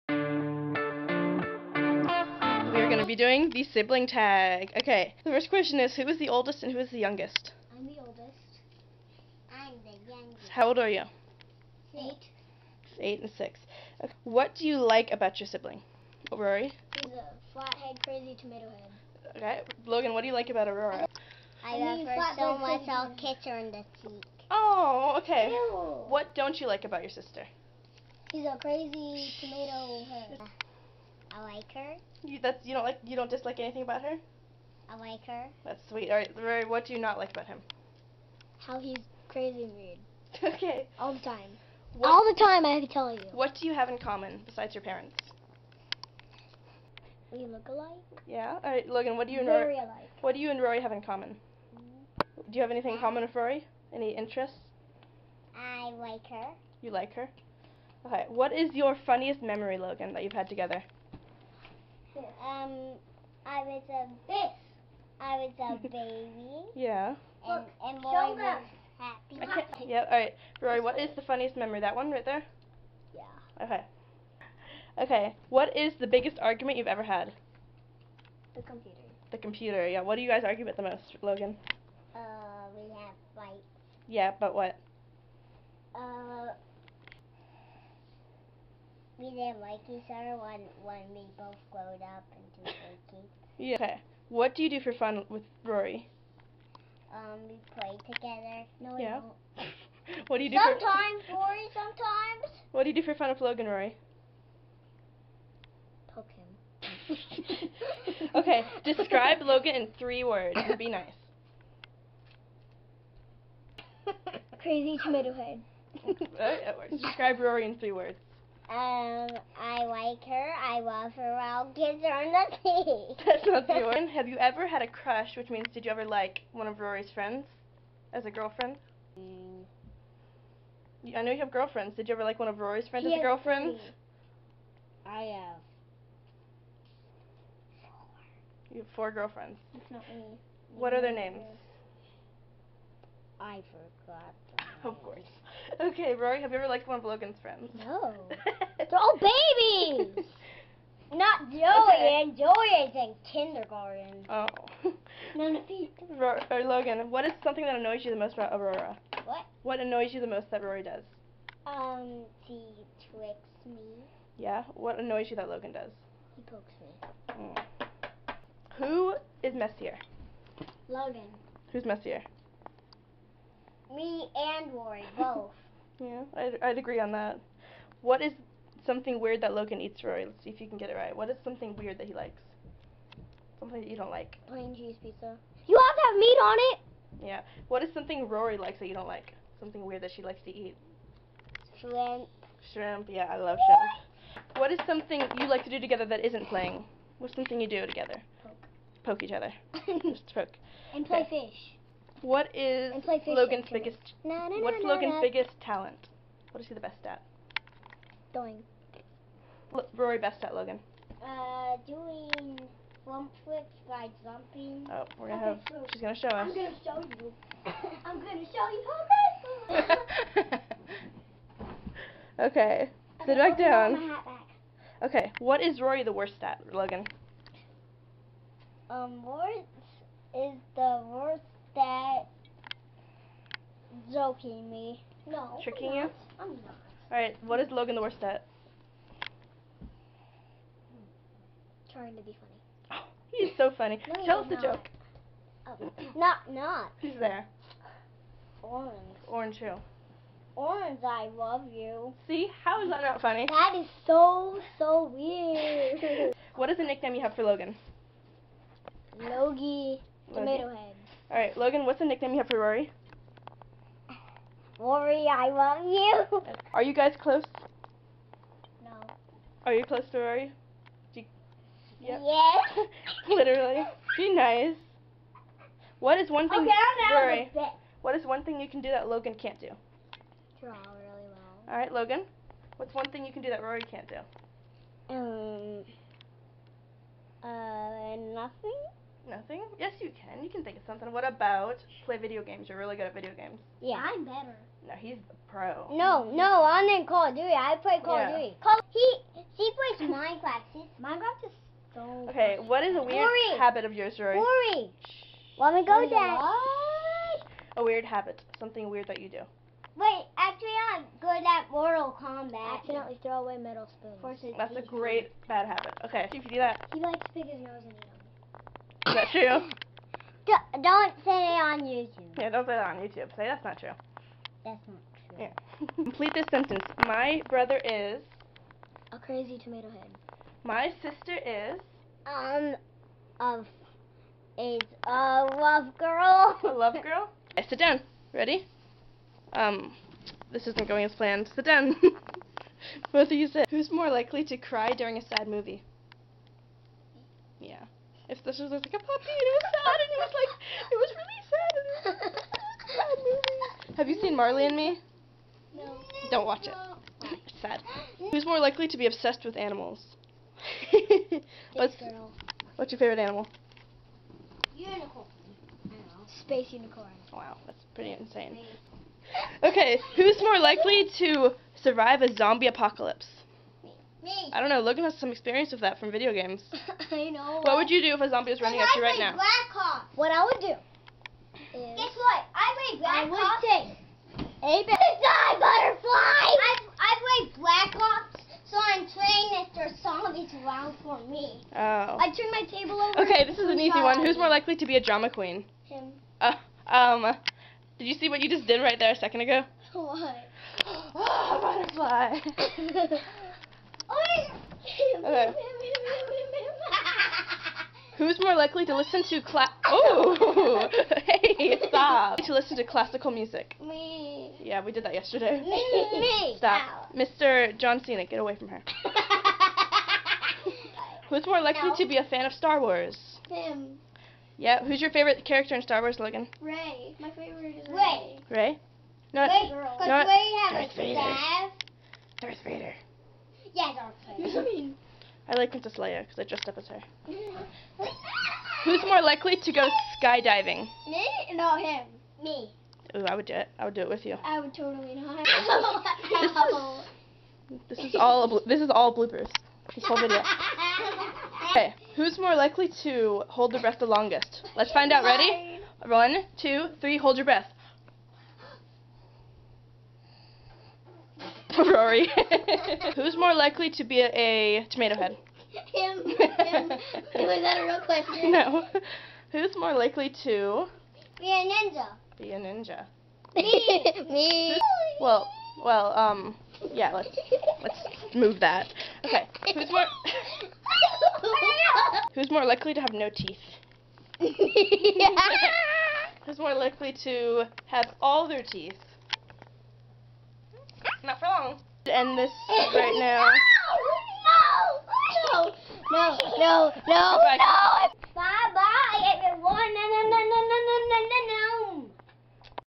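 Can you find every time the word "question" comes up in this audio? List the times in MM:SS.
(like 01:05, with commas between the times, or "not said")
00:05, 07:48.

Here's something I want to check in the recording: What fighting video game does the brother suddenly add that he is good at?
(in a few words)
Mortal Kombat.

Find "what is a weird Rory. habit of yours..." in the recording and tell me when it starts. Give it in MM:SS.
05:02.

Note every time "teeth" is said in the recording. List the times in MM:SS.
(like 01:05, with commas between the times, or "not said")
08:03, 08:08.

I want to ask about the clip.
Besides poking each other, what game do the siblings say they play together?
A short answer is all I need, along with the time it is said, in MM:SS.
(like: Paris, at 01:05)
Fish, at 03:21.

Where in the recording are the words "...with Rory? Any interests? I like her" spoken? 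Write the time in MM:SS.
00:53.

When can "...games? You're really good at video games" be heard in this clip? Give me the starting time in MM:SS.
04:52.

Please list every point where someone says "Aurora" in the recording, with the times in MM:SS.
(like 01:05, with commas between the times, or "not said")
00:20, 02:38.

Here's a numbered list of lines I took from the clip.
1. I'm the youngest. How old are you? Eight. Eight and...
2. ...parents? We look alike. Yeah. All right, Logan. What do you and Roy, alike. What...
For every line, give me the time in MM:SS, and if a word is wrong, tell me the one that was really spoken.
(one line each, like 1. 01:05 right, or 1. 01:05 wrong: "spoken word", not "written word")
1. 00:09 right
2. 00:44 wrong: "Rory", not "Roy".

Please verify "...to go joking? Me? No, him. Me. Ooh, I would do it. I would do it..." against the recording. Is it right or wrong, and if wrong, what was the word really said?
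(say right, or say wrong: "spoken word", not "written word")
wrong: "skydiving", not "joking".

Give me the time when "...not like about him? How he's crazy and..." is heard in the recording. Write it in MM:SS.
00:36.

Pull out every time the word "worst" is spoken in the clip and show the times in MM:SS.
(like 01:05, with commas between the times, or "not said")
03:46, 03:51, 03:58.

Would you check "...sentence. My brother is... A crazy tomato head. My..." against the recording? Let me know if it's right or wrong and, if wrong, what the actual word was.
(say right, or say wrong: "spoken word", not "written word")
right.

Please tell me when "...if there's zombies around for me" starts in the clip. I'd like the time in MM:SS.
06:29.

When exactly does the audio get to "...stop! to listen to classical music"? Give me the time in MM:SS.
06:51.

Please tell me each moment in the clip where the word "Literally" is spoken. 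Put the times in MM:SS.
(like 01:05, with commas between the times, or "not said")
04:33.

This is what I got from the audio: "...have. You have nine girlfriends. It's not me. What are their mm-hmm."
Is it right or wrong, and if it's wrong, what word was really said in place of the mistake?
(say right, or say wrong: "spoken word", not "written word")
wrong: "four", not "nine".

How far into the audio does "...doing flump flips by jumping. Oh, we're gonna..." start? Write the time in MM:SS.
03:31.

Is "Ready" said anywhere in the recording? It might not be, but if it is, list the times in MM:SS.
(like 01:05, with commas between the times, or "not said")
05:38, 07:35.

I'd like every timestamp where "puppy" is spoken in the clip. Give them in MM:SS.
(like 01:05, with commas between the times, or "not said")
05:48.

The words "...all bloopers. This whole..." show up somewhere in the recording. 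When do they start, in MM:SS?
07:28.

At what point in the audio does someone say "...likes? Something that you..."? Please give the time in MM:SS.
03:02.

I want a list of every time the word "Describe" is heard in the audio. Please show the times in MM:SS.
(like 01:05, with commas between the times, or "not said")
01:48, 01:57.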